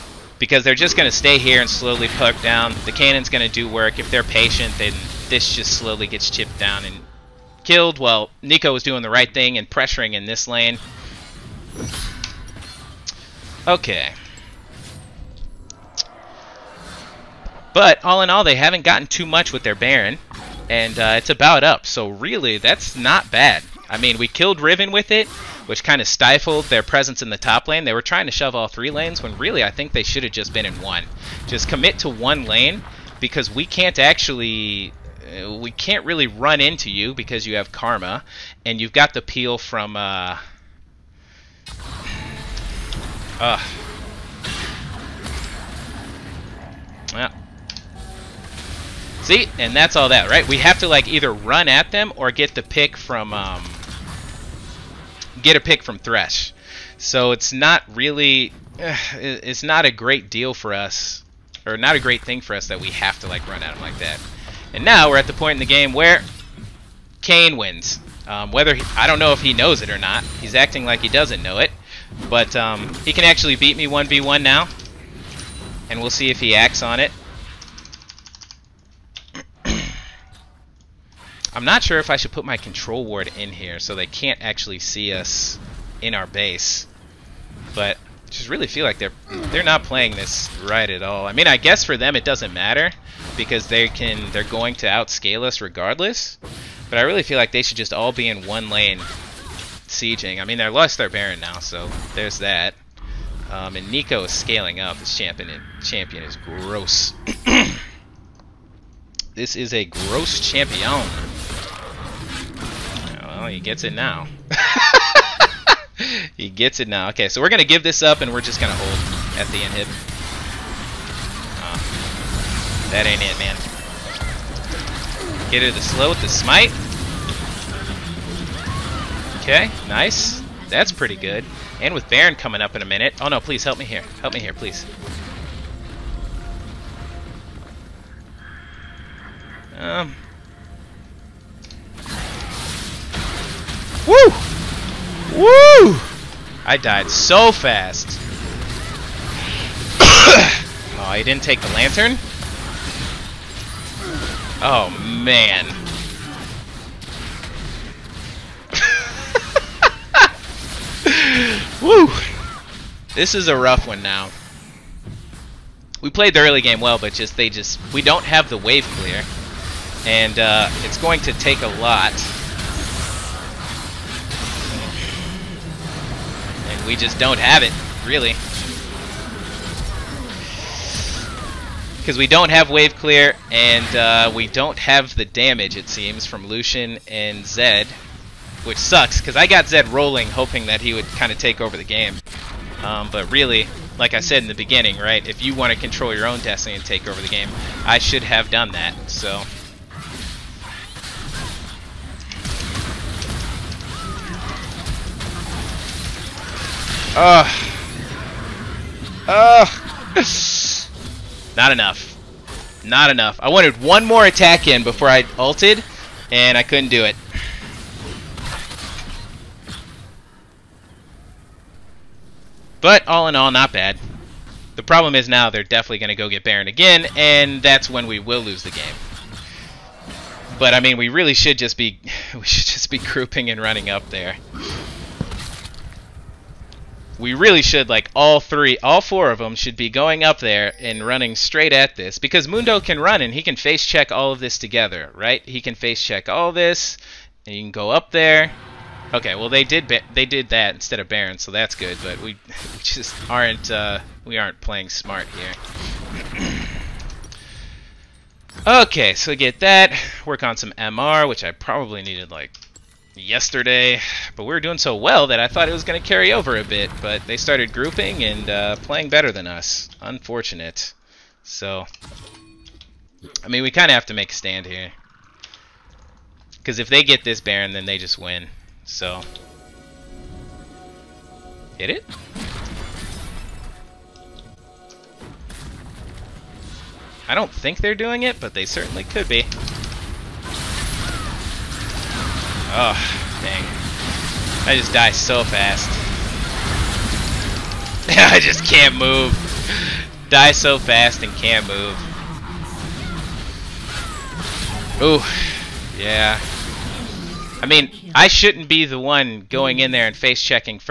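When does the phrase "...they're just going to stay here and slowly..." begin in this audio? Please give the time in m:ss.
0:00.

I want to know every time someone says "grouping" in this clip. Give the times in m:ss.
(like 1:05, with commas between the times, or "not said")
3:52, 4:27.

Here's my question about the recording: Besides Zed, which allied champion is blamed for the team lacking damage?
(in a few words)
Lucian.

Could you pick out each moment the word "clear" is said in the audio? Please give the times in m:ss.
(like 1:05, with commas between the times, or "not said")
2:48, 3:02.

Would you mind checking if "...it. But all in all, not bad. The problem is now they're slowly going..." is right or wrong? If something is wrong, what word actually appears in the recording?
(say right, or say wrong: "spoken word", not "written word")
wrong: "definitely", not "slowly".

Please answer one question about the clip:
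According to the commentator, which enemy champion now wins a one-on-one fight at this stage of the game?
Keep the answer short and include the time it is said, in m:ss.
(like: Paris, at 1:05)
Kayn, at 1:07.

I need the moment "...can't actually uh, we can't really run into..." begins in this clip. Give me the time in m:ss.
0:33.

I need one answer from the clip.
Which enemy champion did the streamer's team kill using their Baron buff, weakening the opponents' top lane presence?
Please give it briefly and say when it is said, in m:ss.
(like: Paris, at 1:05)
Riven, at 0:24.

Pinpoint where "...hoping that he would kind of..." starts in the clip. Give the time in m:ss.
3:10.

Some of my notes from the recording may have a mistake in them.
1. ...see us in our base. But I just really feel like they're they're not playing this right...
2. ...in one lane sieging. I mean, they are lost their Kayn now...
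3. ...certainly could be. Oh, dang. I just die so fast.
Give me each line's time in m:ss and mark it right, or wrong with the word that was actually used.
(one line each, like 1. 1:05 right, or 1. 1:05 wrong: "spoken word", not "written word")
1. 1:24 right
2. 1:38 wrong: "Baron", not "Kayn"
3. 4:48 right.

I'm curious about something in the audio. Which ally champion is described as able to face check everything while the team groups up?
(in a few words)
Mundo.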